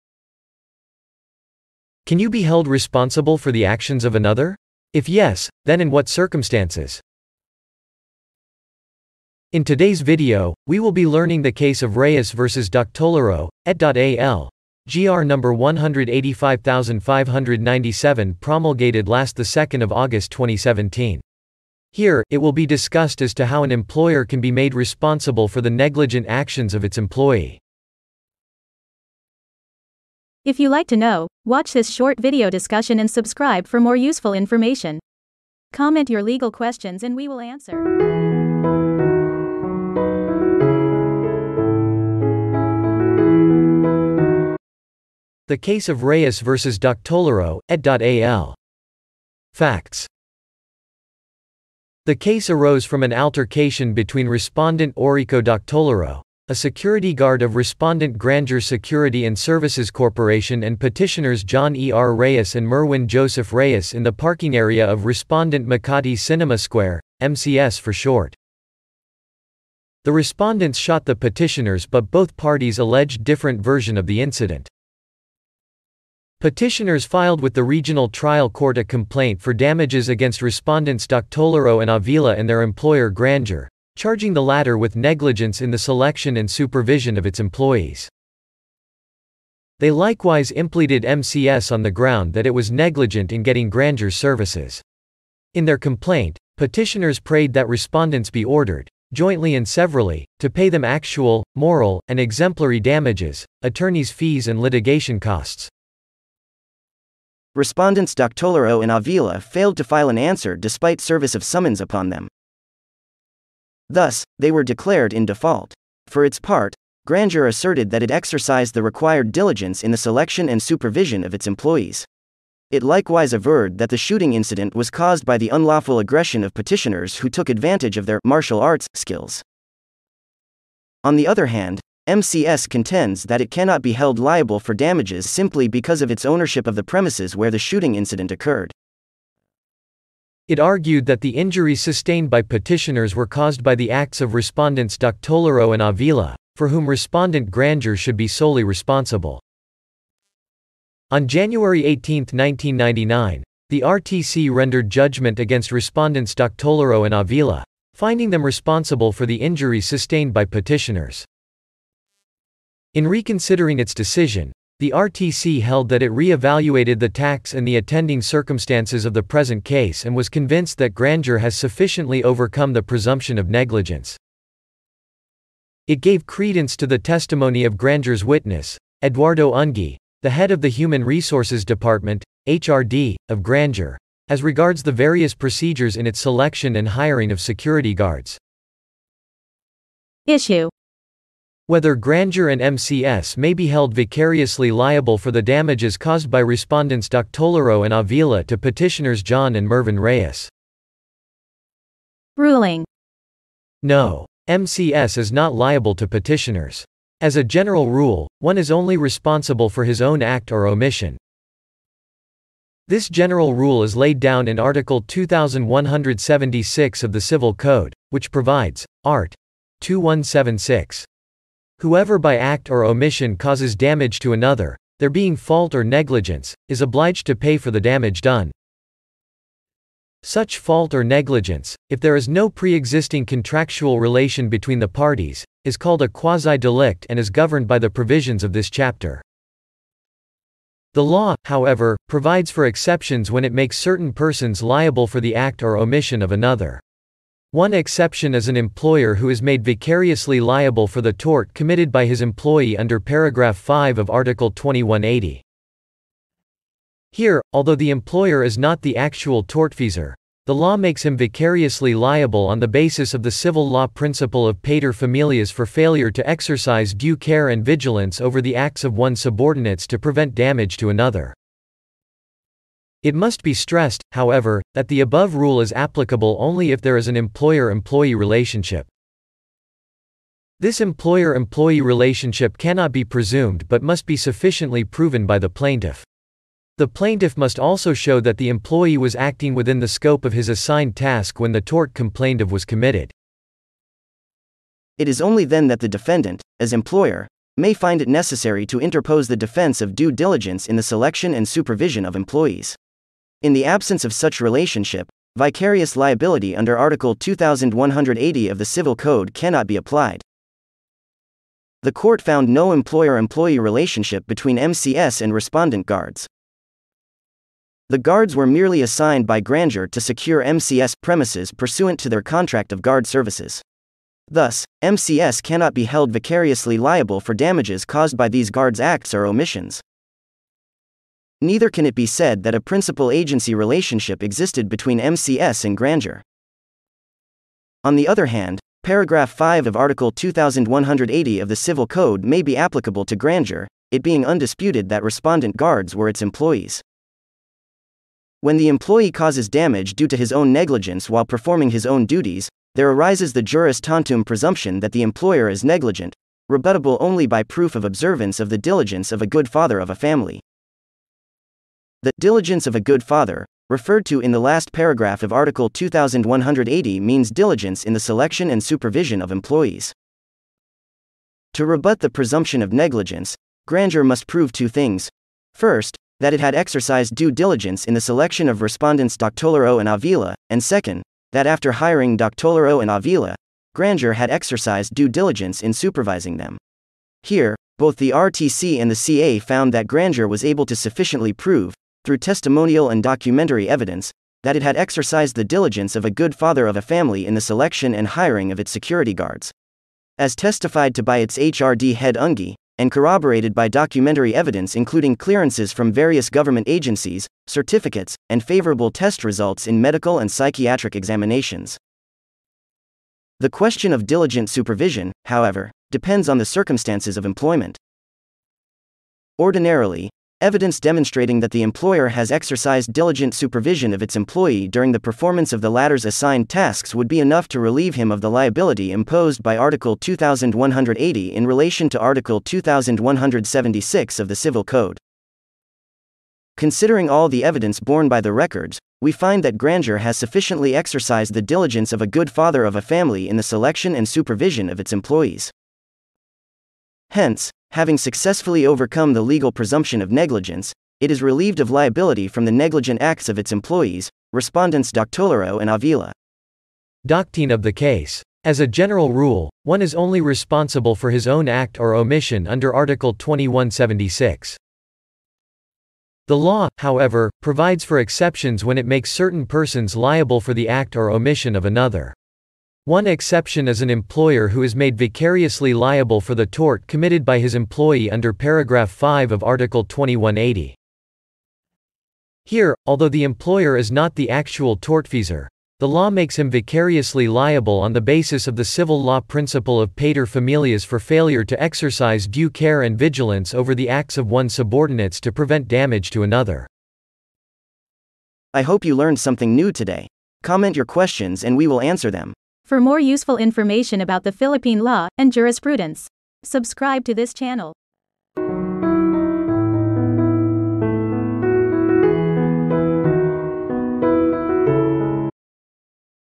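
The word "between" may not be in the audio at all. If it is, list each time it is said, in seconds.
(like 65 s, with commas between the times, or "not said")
53 s, 234 s, 314 s, 334 s.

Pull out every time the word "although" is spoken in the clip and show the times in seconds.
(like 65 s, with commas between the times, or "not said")
257 s, 482 s.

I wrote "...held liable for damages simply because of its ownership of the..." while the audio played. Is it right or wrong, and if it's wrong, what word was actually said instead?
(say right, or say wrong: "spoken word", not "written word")
right.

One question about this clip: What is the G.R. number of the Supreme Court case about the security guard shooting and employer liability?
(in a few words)
185597.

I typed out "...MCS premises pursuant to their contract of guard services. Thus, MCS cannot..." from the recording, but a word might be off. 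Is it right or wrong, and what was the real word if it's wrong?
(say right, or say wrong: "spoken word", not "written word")
right.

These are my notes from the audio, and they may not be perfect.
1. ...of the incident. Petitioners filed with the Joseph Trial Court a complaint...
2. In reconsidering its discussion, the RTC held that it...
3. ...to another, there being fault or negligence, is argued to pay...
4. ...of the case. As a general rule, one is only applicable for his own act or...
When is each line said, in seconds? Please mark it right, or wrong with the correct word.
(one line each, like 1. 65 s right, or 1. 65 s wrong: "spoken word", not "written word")
1. 73 s wrong: "Regional", not "Joseph"
2. 162 s wrong: "decision", not "discussion"
3. 224 s wrong: "obliged", not "argued"
4. 457 s wrong: "responsible", not "applicable".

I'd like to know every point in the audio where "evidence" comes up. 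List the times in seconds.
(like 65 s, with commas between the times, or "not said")
393 s, 404 s, 420 s, 437 s.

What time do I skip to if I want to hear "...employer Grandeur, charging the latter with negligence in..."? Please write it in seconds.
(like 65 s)
82 s.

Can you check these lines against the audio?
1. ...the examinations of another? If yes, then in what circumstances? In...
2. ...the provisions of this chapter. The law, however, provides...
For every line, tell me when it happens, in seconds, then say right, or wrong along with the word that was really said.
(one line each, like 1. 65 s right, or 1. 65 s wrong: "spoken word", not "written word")
1. 3 s wrong: "actions", not "examinations"
2. 237 s right.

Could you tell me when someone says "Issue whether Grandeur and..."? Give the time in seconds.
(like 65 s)
190 s.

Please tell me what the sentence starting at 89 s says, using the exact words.
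They likewise impleaded MCS on the ground that it was negligent in getting grandeur services.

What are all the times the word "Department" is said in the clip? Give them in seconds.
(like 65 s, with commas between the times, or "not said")
181 s.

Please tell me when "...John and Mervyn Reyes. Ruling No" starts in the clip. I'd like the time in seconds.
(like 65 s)
199 s.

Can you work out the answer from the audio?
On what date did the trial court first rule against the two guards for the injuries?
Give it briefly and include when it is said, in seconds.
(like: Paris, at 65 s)
January 18, 1999, at 151 s.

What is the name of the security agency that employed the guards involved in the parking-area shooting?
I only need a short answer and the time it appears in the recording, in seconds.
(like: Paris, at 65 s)
Grandeur Security and Services Corporation, at 58 s.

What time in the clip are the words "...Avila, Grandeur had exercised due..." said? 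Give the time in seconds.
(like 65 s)
382 s.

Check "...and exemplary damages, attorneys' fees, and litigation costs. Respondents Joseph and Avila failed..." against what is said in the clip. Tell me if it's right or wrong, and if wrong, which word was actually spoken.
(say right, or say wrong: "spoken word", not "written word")
wrong: "Doctolero", not "Joseph".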